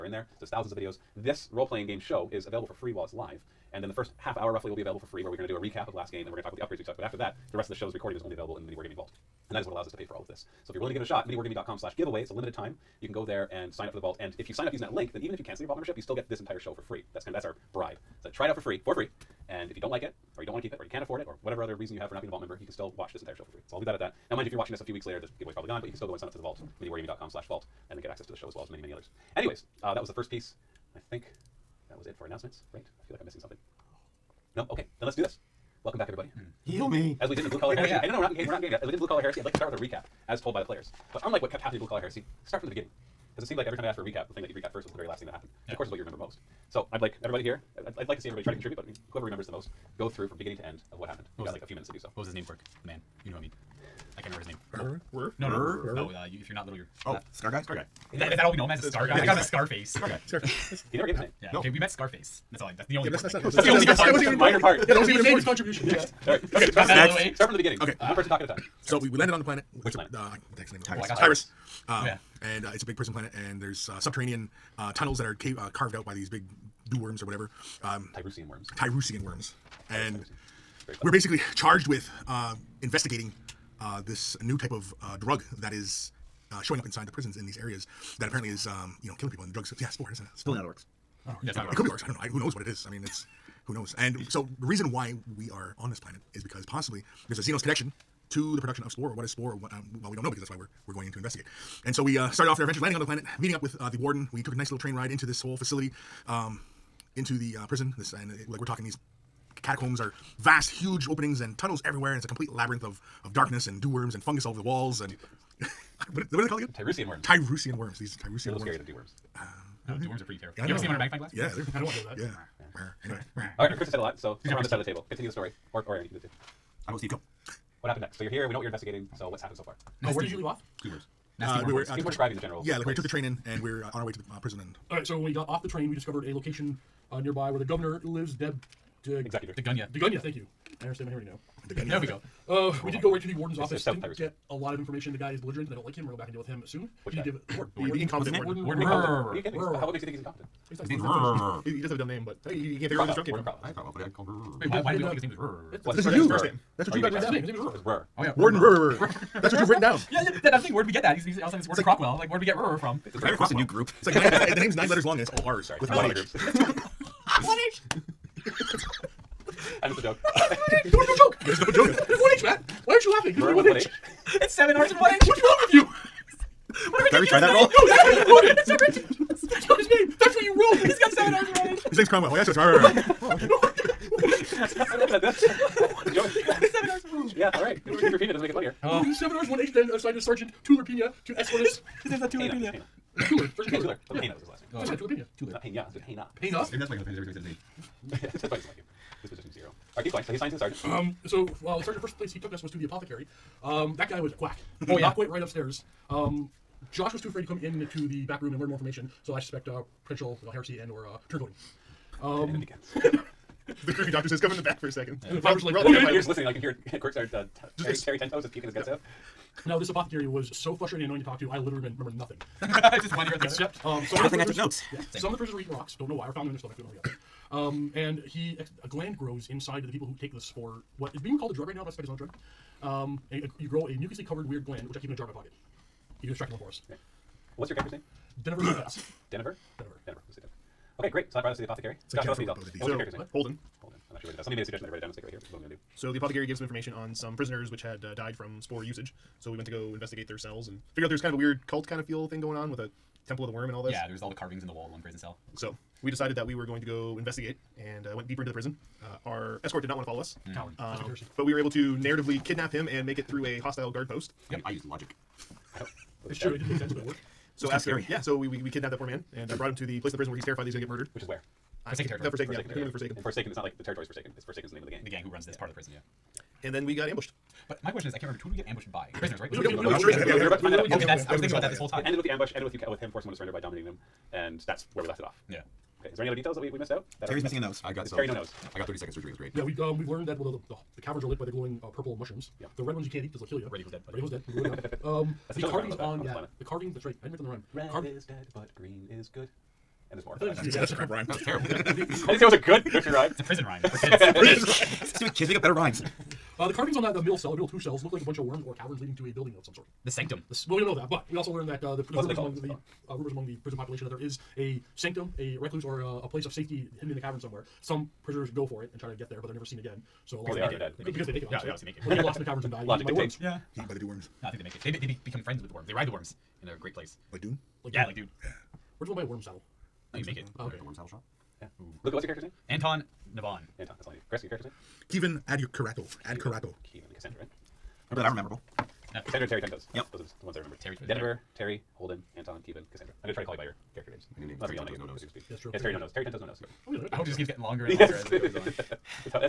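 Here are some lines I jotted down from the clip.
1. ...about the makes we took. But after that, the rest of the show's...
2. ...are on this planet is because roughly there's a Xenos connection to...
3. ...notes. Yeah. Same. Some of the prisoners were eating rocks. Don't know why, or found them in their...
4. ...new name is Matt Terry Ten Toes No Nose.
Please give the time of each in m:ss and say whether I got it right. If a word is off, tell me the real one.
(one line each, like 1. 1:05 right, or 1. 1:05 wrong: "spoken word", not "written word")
1. 0:06 wrong: "upgrades", not "makes"
2. 1:35 wrong: "possibly", not "roughly"
3. 3:44 right
4. 5:44 wrong: "Unless", not "Matt".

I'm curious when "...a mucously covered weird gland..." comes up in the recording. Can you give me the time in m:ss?
3:53.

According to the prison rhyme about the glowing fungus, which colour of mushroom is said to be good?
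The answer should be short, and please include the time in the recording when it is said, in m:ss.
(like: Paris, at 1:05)
green, at 4:58.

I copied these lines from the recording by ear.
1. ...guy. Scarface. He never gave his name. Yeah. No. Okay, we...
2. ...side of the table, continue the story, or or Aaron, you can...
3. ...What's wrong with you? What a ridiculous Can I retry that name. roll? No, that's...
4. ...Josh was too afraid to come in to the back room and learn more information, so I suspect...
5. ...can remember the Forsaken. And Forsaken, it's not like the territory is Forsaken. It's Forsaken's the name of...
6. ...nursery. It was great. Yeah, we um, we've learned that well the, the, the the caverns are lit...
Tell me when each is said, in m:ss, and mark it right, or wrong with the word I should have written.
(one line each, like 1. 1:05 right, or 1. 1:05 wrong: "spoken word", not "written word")
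1. 1:00 right
2. 2:04 right
3. 2:55 right
4. 3:26 right
5. 4:32 right
6. 4:49 wrong: "surgery", not "nursery".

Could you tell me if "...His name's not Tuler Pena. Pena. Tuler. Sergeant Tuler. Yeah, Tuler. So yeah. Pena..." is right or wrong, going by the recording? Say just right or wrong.
right.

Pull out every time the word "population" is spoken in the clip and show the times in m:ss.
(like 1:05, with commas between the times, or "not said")
5:13.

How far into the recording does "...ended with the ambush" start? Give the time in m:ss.
4:42.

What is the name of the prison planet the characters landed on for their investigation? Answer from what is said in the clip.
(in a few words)
Tyrus.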